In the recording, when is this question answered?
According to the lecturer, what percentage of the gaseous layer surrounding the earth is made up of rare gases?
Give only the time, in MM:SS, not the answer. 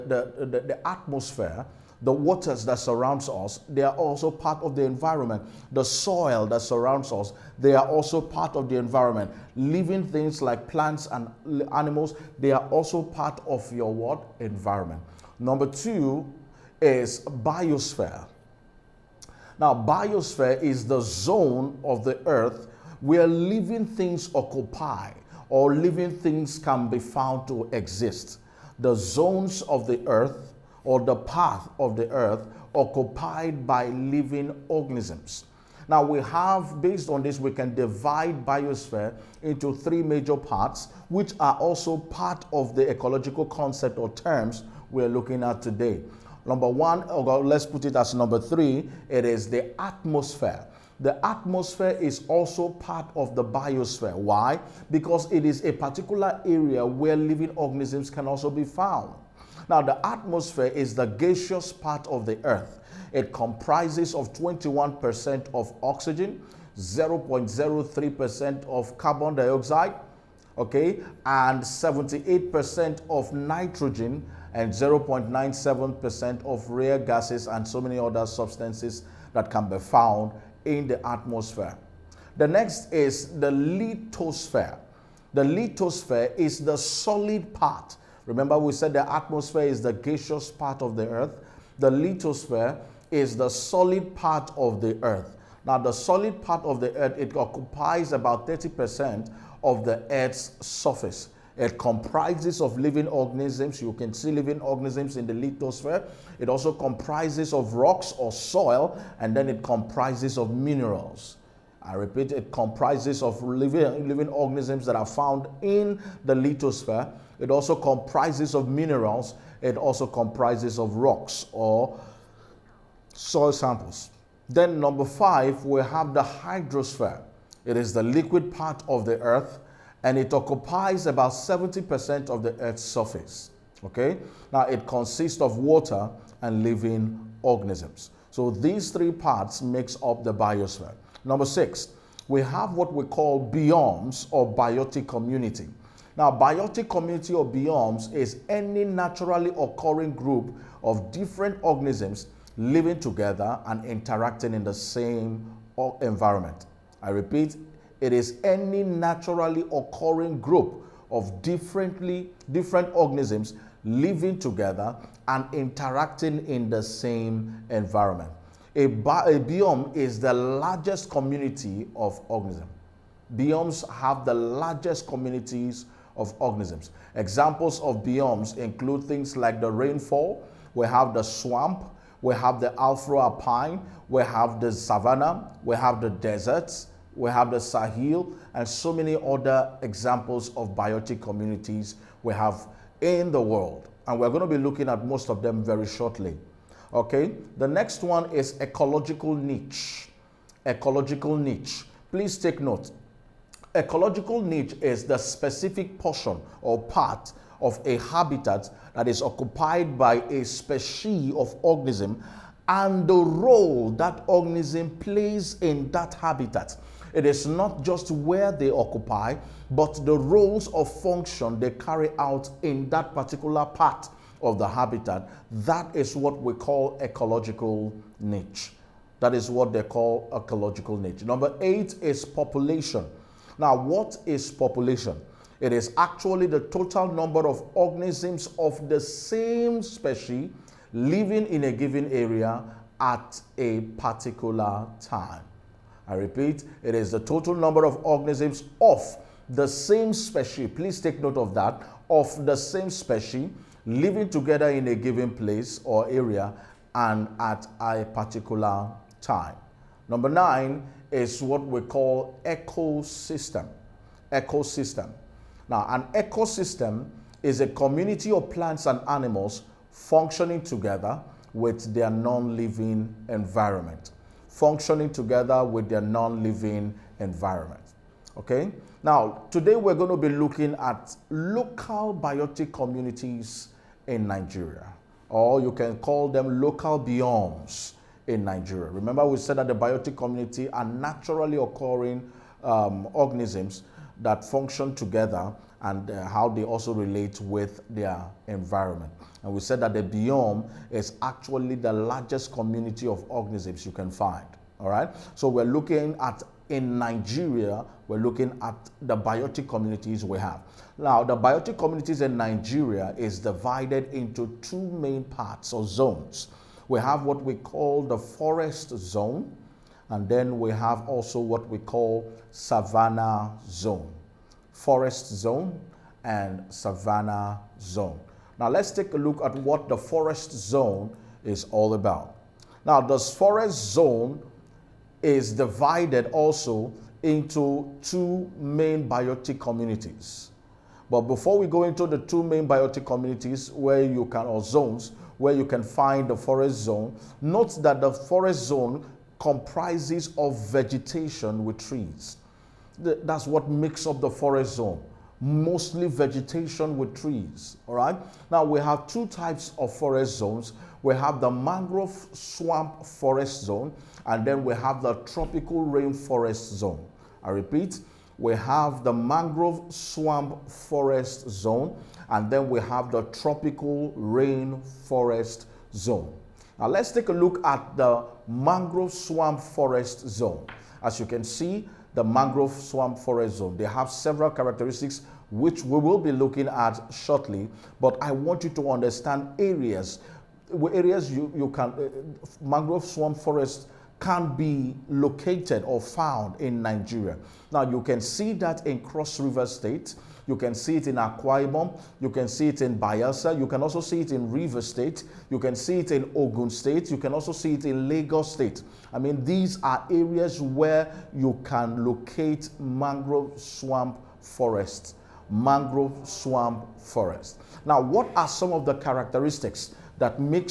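01:14.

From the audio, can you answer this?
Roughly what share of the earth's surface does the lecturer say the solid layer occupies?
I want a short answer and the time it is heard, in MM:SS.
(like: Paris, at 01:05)
30%, at 01:38.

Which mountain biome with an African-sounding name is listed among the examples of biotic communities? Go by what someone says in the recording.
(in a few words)
Afro-Alpine.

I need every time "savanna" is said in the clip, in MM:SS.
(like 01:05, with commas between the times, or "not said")
03:04, 05:22, 05:26.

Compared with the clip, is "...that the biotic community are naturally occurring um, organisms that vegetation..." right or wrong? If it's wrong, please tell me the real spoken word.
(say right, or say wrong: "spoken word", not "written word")
wrong: "function", not "vegetation".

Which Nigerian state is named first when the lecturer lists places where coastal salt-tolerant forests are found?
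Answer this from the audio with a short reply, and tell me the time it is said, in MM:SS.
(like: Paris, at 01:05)
Cross River State, at 06:38.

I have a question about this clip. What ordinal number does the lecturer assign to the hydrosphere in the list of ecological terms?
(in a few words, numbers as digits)
5.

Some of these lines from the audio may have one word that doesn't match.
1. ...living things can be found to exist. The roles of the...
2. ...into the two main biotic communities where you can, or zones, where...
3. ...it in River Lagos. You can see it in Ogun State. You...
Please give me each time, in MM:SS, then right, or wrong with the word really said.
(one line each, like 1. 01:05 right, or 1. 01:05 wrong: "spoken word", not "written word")
1. 00:25 wrong: "zones", not "roles"
2. 05:41 right
3. 06:44 wrong: "State", not "Lagos".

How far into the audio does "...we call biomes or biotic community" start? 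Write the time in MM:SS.
02:22.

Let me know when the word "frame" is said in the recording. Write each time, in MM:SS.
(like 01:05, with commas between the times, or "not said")
not said.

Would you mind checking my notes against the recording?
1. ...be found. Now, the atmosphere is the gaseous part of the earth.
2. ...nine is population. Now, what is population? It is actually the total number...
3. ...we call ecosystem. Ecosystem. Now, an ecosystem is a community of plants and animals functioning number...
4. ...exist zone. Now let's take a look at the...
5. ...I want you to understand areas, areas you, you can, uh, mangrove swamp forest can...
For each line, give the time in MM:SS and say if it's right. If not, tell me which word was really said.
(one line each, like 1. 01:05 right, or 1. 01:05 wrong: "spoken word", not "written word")
1. 00:58 right
2. 03:51 wrong: "eight", not "nine"
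3. 04:21 wrong: "together", not "number"
4. 06:14 wrong: "rainforest", not "exist"
5. 06:28 right.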